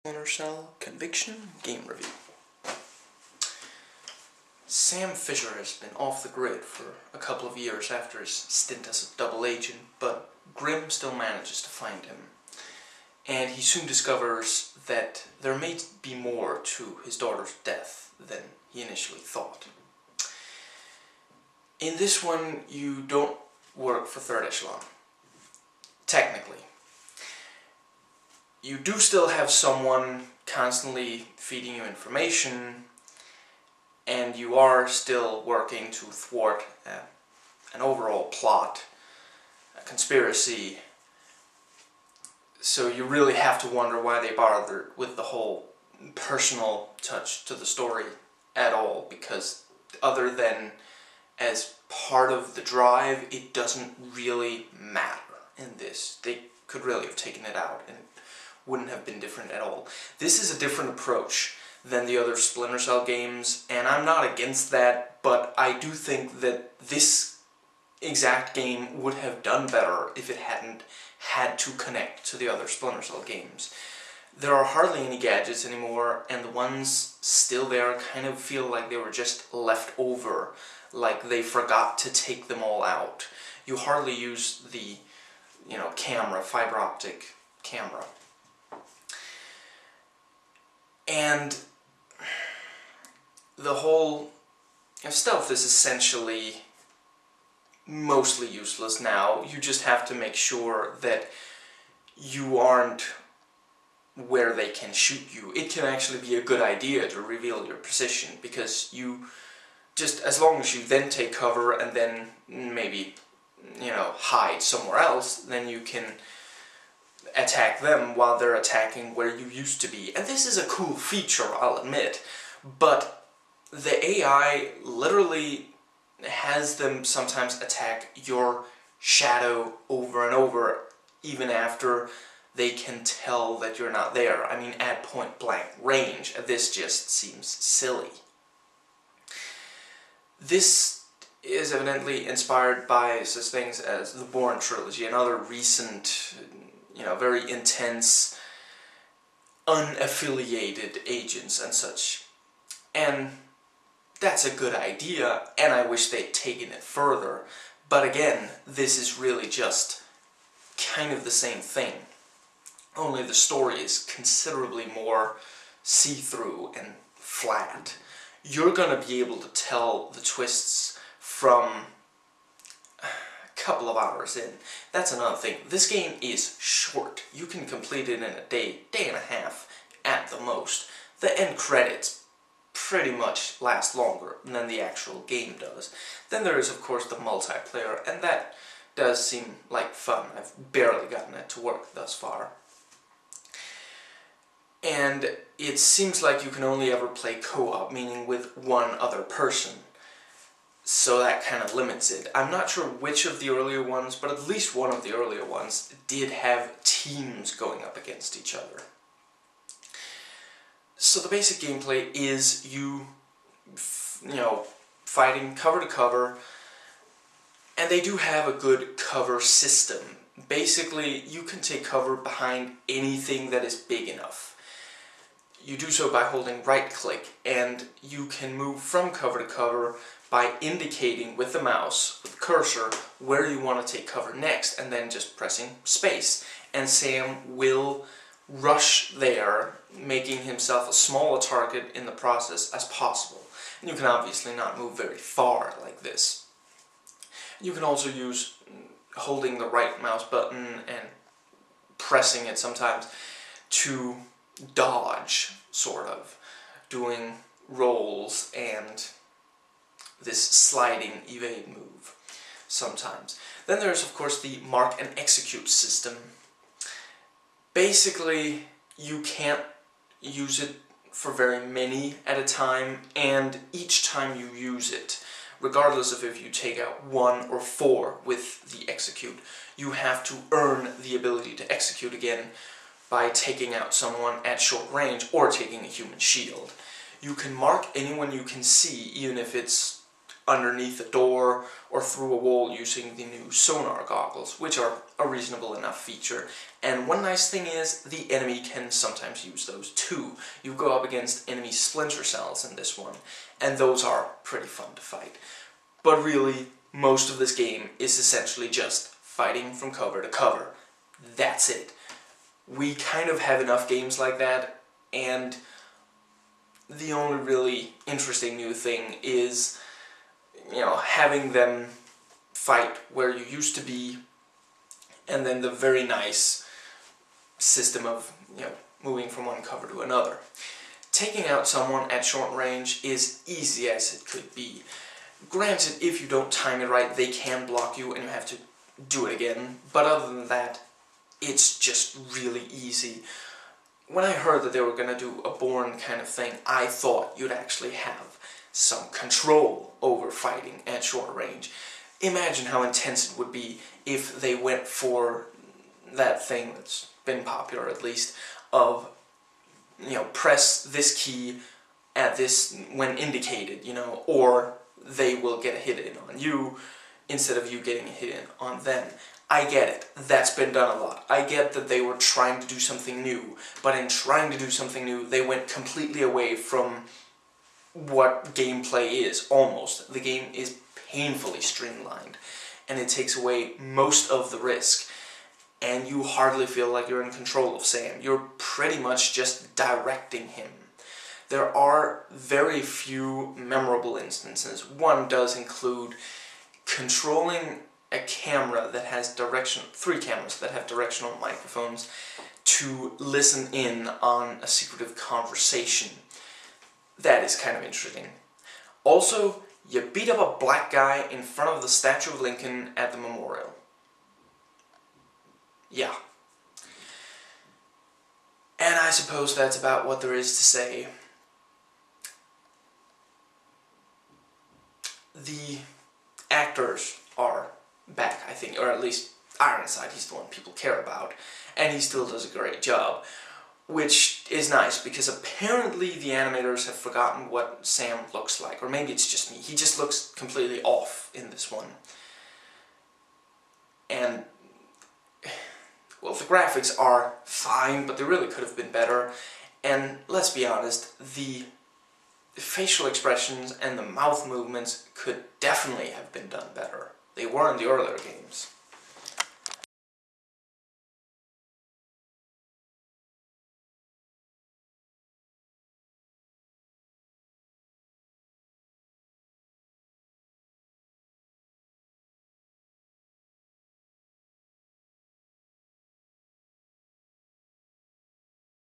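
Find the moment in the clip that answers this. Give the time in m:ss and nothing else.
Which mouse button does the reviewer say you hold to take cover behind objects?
3:46.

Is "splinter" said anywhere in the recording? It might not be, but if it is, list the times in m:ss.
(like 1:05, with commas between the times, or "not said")
1:02, 1:12, 5:01.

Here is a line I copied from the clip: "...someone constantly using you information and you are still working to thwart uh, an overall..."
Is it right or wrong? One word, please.
wrong.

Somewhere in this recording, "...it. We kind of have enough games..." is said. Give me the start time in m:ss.
5:11.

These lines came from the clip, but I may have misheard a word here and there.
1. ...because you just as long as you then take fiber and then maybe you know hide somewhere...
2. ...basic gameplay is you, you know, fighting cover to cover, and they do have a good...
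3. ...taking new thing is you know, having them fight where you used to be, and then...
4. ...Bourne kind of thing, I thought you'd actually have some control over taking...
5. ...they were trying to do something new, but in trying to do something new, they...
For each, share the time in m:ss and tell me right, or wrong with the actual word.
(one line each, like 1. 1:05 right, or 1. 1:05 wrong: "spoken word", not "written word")
1. 1:48 wrong: "cover", not "fiber"
2. 3:31 right
3. 5:18 wrong: "interesting", not "taking"
4. 5:45 wrong: "fighting", not "taking"
5. 6:11 right.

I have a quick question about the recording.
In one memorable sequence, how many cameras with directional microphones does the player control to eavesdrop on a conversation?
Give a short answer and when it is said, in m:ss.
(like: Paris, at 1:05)
3, at 6:39.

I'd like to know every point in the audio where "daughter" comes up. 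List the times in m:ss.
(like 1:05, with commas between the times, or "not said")
0:17.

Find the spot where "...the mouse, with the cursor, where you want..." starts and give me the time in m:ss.
3:51.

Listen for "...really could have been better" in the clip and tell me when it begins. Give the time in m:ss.
7:28.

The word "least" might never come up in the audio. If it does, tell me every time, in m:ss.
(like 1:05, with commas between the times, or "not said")
3:24, 5:58, 7:09.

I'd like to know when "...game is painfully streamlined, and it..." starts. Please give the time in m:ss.
6:20.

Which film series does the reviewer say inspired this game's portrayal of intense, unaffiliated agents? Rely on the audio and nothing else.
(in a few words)
the Bourne trilogy.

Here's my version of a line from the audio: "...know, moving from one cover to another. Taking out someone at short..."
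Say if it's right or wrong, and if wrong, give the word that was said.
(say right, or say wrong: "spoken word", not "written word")
right.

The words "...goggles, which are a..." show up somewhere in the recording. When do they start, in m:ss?
4:54.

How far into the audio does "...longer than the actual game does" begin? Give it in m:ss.
3:03.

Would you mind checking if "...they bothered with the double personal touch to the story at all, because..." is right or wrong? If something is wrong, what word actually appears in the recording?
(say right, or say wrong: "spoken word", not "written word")
wrong: "whole", not "double".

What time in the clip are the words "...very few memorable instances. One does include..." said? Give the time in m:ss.
6:32.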